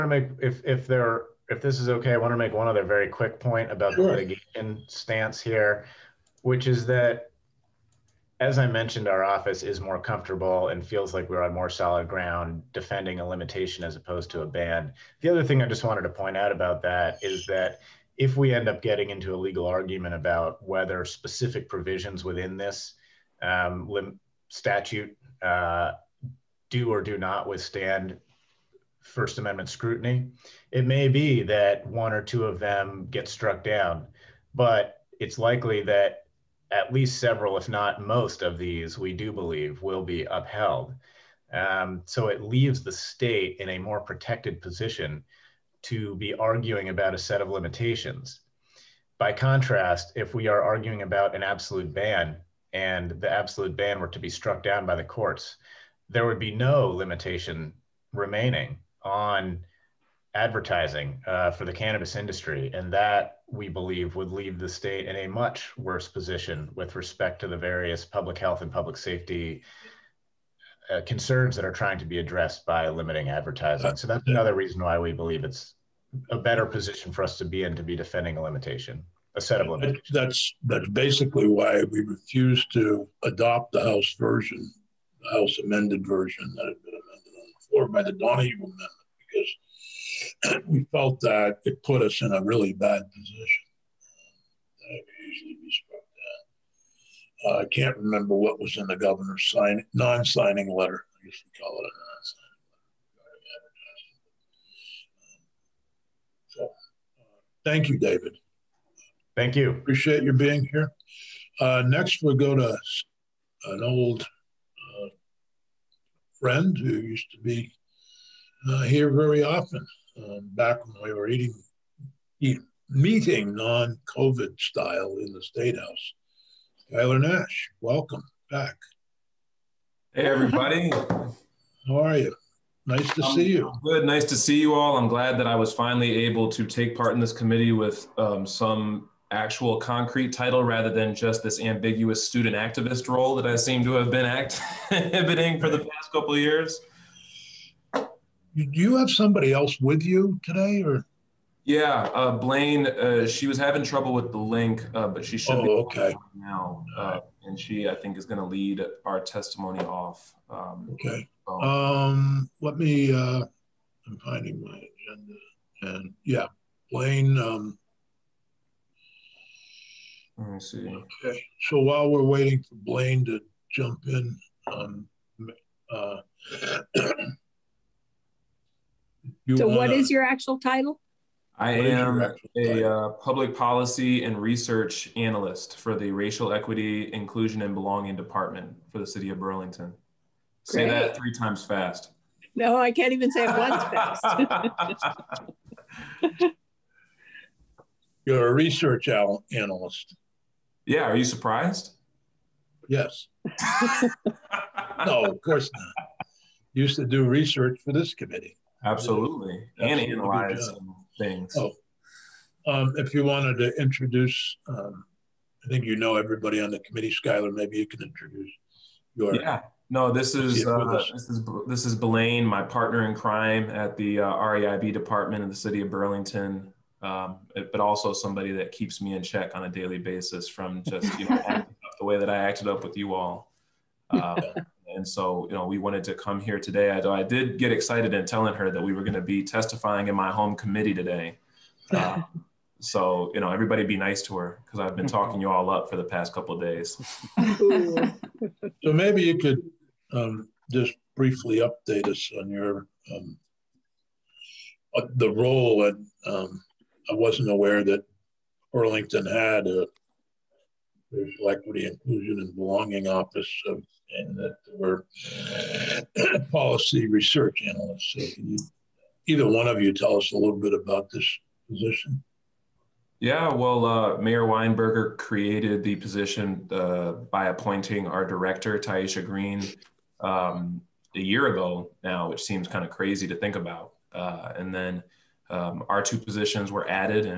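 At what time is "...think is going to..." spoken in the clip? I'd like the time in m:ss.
2:37.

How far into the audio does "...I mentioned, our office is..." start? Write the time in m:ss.
0:08.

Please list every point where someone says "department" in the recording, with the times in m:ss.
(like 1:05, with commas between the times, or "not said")
3:08, 3:44.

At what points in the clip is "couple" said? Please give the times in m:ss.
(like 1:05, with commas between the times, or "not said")
2:26, 4:06.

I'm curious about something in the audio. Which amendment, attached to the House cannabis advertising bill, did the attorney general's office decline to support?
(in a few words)
Donahue Amendment.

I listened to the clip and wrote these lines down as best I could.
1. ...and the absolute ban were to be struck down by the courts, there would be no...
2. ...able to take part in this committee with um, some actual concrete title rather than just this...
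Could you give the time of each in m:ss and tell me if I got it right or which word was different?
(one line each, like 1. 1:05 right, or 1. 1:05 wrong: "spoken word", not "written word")
1. 0:52 right
2. 2:16 right.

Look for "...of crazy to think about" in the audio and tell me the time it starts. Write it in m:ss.
4:42.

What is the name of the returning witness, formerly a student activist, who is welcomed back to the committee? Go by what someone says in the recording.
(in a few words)
Skylar Nash.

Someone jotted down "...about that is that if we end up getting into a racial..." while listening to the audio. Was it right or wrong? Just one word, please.
wrong.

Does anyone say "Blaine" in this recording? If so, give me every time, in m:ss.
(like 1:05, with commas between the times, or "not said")
2:32, 2:46, 2:52.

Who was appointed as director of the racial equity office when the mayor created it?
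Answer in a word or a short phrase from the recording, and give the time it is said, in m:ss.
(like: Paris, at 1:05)
Taisha Green, at 4:38.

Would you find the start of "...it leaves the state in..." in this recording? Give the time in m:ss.
0:42.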